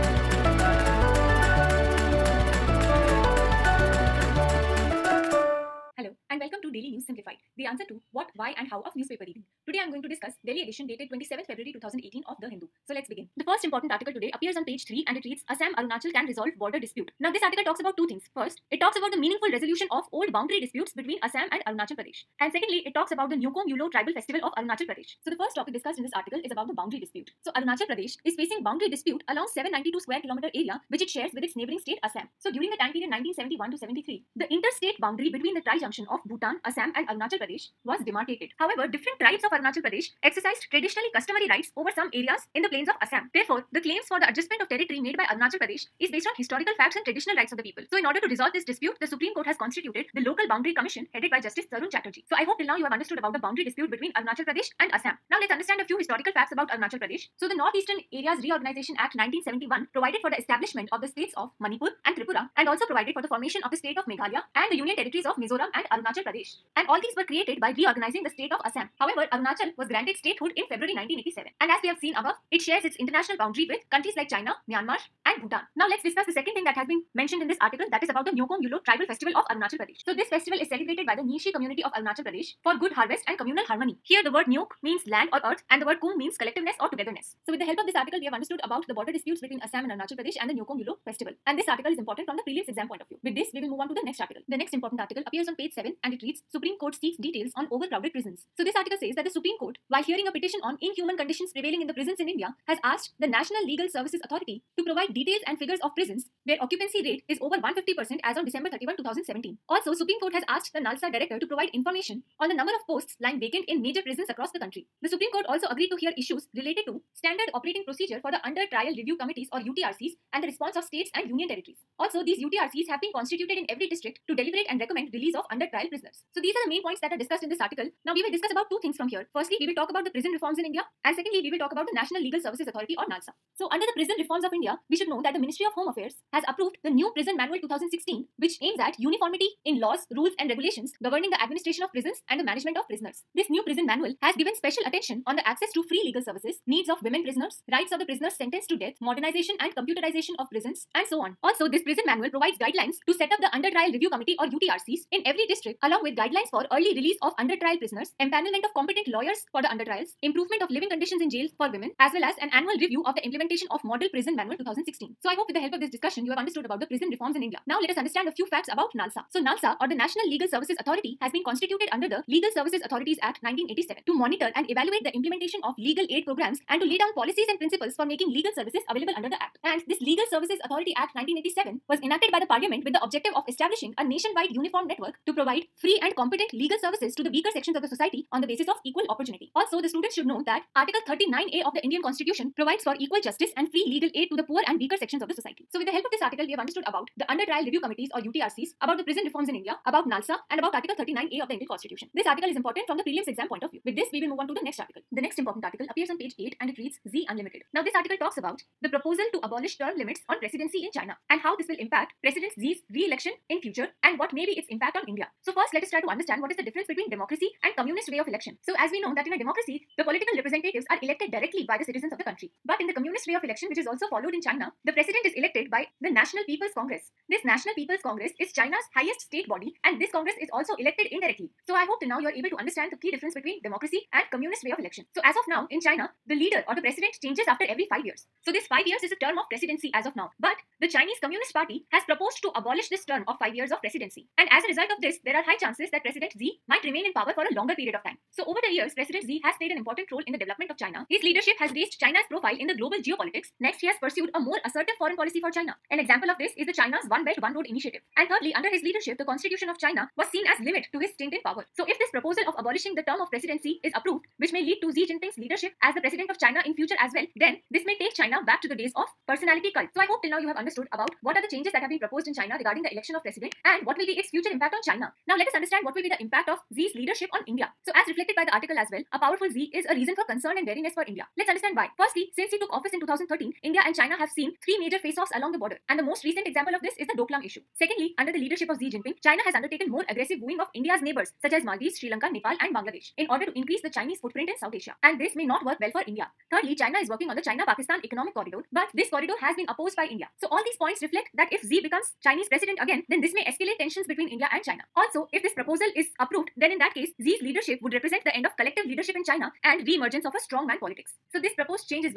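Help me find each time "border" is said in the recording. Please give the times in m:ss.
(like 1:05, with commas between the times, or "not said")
0:16, 1:28, 4:45.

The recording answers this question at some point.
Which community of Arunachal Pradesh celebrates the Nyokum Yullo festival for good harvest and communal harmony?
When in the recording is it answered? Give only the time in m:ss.
1:21.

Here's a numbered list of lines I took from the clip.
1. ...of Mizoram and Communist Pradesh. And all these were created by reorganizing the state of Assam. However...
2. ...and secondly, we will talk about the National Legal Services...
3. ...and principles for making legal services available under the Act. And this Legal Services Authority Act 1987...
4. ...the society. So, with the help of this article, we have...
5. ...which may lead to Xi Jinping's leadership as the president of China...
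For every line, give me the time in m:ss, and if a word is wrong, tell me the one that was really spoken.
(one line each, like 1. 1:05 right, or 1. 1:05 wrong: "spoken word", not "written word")
1. 1:05 wrong: "Arunachal", not "Communist"
2. 2:11 right
3. 2:57 right
4. 3:15 right
5. 4:24 right.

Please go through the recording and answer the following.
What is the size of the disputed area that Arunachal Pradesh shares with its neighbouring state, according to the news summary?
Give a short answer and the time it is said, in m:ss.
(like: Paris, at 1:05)
792 square kilometers, at 0:29.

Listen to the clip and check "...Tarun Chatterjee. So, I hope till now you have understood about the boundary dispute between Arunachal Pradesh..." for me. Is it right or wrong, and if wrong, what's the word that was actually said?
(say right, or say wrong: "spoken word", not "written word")
right.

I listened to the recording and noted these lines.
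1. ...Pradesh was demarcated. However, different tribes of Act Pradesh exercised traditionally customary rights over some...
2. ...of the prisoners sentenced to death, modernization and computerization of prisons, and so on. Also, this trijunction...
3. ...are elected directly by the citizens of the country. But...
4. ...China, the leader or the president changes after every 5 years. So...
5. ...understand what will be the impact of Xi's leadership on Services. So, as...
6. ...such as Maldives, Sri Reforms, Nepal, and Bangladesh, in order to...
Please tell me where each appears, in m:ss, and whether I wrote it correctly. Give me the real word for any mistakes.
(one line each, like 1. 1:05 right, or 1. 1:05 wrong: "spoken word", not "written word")
1. 0:37 wrong: "Arunachal", not "Act"
2. 2:27 wrong: "prison", not "trijunction"
3. 3:40 right
4. 3:55 right
5. 4:35 wrong: "India", not "Services"
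6. 4:51 wrong: "Lanka", not "Reforms".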